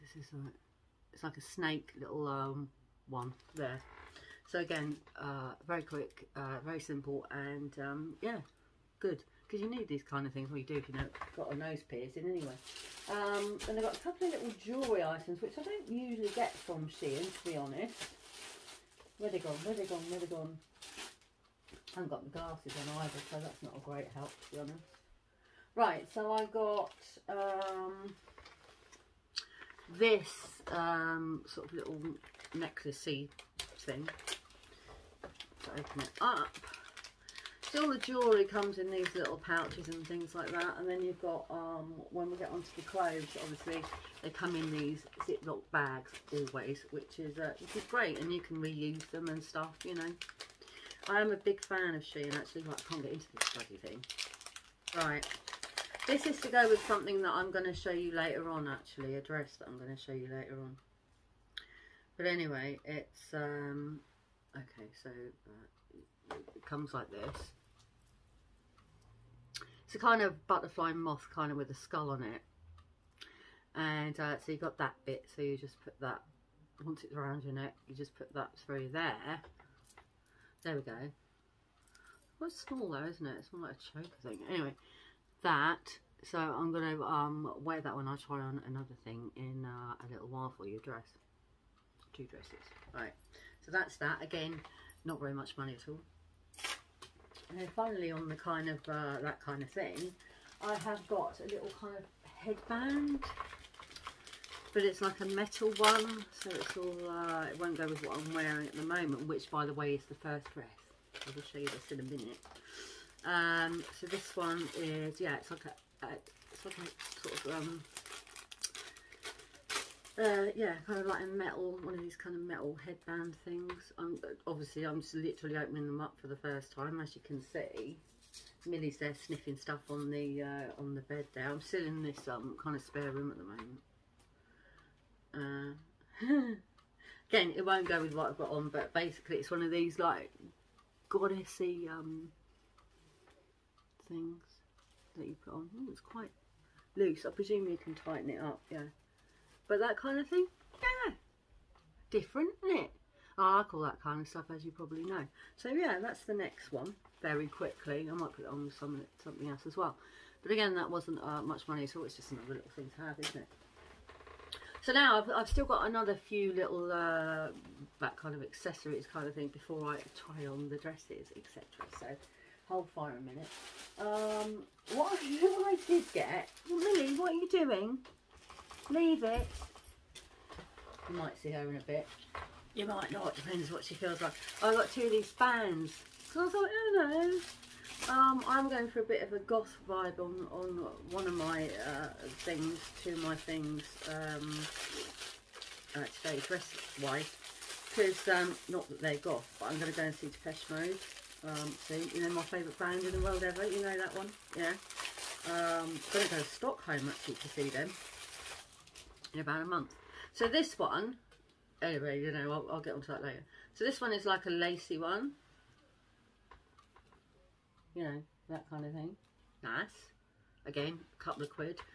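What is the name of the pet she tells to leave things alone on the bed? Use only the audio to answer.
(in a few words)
Lily.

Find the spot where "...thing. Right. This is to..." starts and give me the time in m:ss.
0:53.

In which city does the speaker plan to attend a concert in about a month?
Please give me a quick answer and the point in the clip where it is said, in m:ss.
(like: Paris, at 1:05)
Stockholm, at 3:26.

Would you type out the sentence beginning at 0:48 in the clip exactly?
And you can reuse them and stuff, you know.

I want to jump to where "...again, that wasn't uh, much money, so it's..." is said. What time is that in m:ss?
2:40.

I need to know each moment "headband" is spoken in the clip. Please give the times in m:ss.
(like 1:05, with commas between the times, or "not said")
1:42, 2:02.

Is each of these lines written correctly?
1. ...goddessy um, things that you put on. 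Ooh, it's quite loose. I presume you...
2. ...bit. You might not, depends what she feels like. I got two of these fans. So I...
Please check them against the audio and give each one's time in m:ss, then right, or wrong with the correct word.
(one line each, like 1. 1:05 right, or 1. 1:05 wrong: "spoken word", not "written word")
1. 2:21 right
2. 3:01 right.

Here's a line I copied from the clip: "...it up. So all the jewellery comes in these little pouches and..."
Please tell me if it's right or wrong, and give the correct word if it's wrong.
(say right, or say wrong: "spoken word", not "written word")
right.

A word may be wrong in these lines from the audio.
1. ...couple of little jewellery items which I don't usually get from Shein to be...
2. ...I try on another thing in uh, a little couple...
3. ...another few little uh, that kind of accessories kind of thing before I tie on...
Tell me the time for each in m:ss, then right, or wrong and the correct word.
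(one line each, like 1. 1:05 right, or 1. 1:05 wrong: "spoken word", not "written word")
1. 0:13 right
2. 1:28 wrong: "while", not "couple"
3. 2:45 right.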